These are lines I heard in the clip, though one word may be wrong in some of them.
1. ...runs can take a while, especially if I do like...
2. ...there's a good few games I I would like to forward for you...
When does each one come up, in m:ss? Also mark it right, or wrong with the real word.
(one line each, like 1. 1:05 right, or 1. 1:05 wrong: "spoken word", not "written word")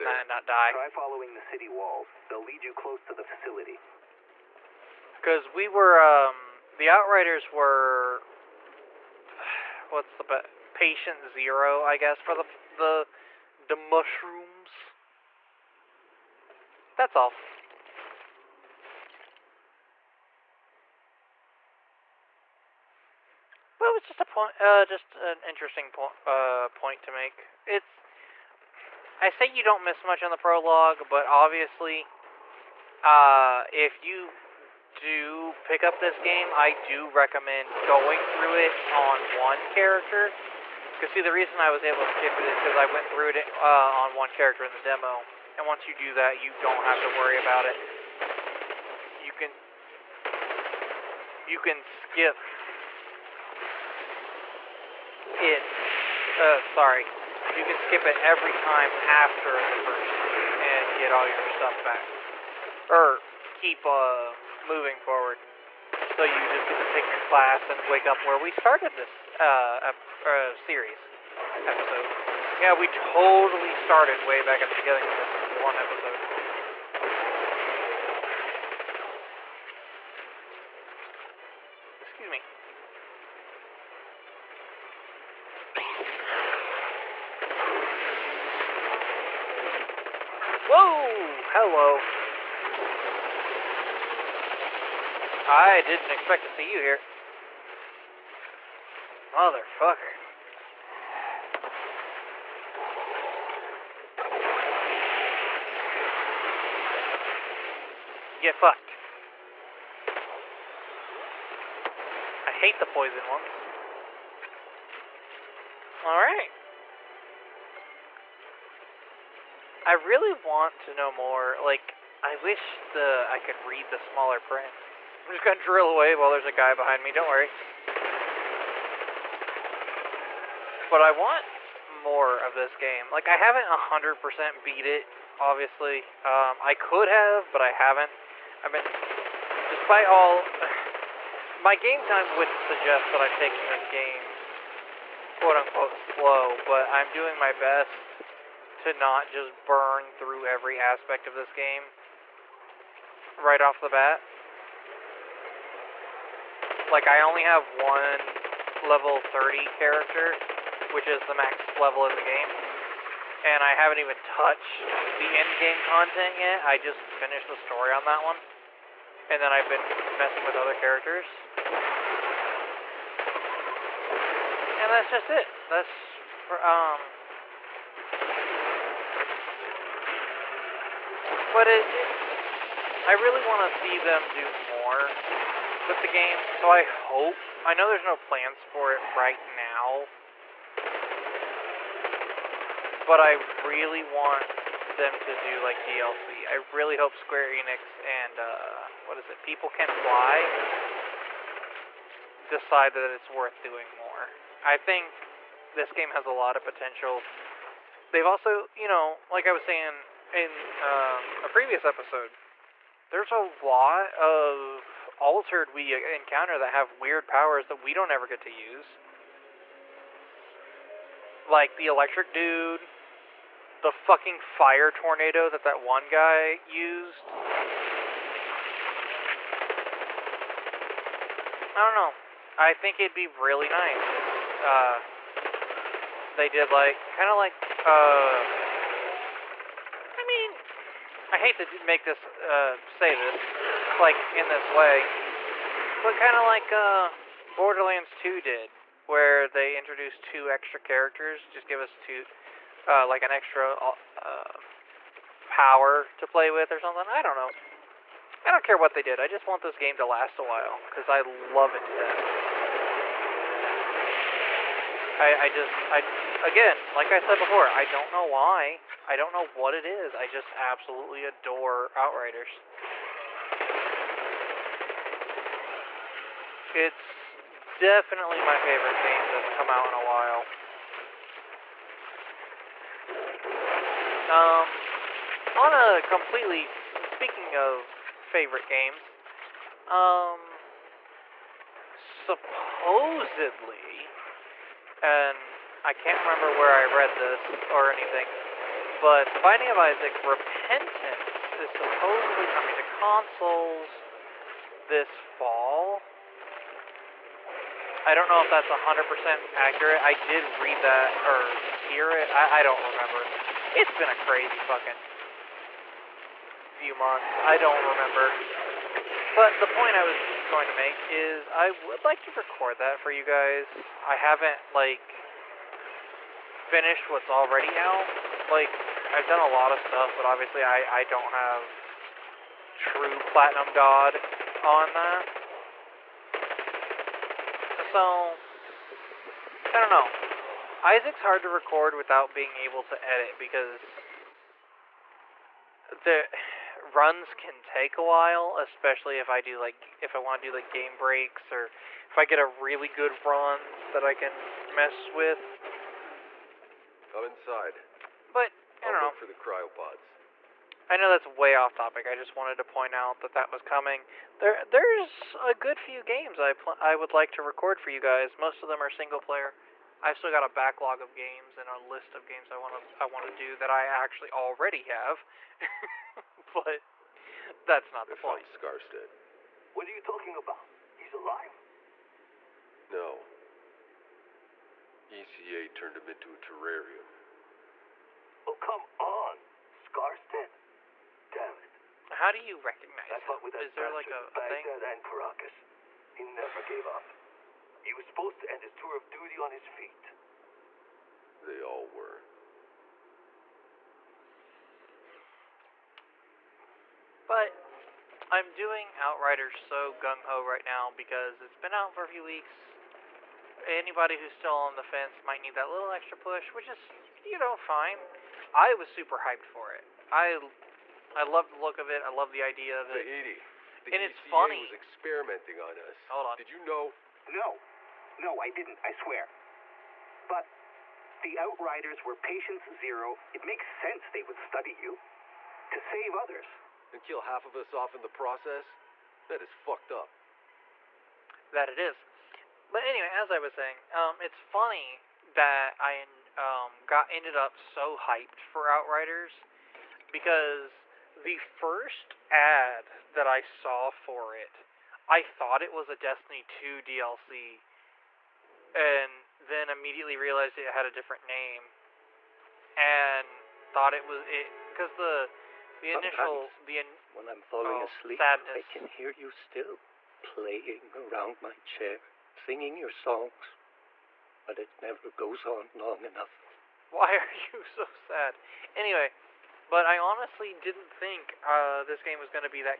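1. 5:46 right
2. 6:04 wrong: "record", not "forward".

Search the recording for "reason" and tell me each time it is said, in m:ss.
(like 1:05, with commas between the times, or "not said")
0:41.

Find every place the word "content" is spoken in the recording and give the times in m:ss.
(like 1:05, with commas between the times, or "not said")
2:45.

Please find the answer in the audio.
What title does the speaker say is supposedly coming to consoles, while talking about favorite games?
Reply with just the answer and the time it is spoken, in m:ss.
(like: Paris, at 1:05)
Binding of Isaac Repentance, at 4:59.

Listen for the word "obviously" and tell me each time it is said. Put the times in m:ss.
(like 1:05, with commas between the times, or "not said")
0:31, 2:15, 5:30.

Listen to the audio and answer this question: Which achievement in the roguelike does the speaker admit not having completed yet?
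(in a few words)
True Platinum God.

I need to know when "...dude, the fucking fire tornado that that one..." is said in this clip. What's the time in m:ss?
3:42.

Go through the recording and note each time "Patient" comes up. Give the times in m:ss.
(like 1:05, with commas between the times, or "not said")
0:10, 7:12.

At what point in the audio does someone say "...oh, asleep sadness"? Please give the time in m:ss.
7:47.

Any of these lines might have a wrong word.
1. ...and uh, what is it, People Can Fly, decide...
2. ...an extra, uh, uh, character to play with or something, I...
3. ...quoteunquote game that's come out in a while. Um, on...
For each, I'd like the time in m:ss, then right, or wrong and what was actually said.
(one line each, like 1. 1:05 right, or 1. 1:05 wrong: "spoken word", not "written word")
1. 3:18 right
2. 4:13 wrong: "power", not "character"
3. 4:38 wrong: "favorite", not "quoteunquote".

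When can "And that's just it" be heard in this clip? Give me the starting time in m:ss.
2:54.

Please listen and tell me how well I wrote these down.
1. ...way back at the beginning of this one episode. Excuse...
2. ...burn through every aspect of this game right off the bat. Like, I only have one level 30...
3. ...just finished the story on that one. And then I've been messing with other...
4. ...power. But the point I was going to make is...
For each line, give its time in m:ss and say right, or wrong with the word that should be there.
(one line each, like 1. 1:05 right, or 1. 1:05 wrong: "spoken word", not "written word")
1. 1:14 right
2. 2:29 right
3. 2:46 right
4. 5:17 wrong: "remember", not "power".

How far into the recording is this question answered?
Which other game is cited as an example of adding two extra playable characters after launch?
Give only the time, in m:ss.
4:07.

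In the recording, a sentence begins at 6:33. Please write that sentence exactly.
Is there like a, a thing?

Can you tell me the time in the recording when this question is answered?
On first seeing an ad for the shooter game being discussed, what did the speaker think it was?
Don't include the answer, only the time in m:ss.
7:35.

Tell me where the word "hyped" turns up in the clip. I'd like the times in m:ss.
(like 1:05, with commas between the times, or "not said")
6:59, 7:27.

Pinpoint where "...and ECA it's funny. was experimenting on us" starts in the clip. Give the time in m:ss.
7:03.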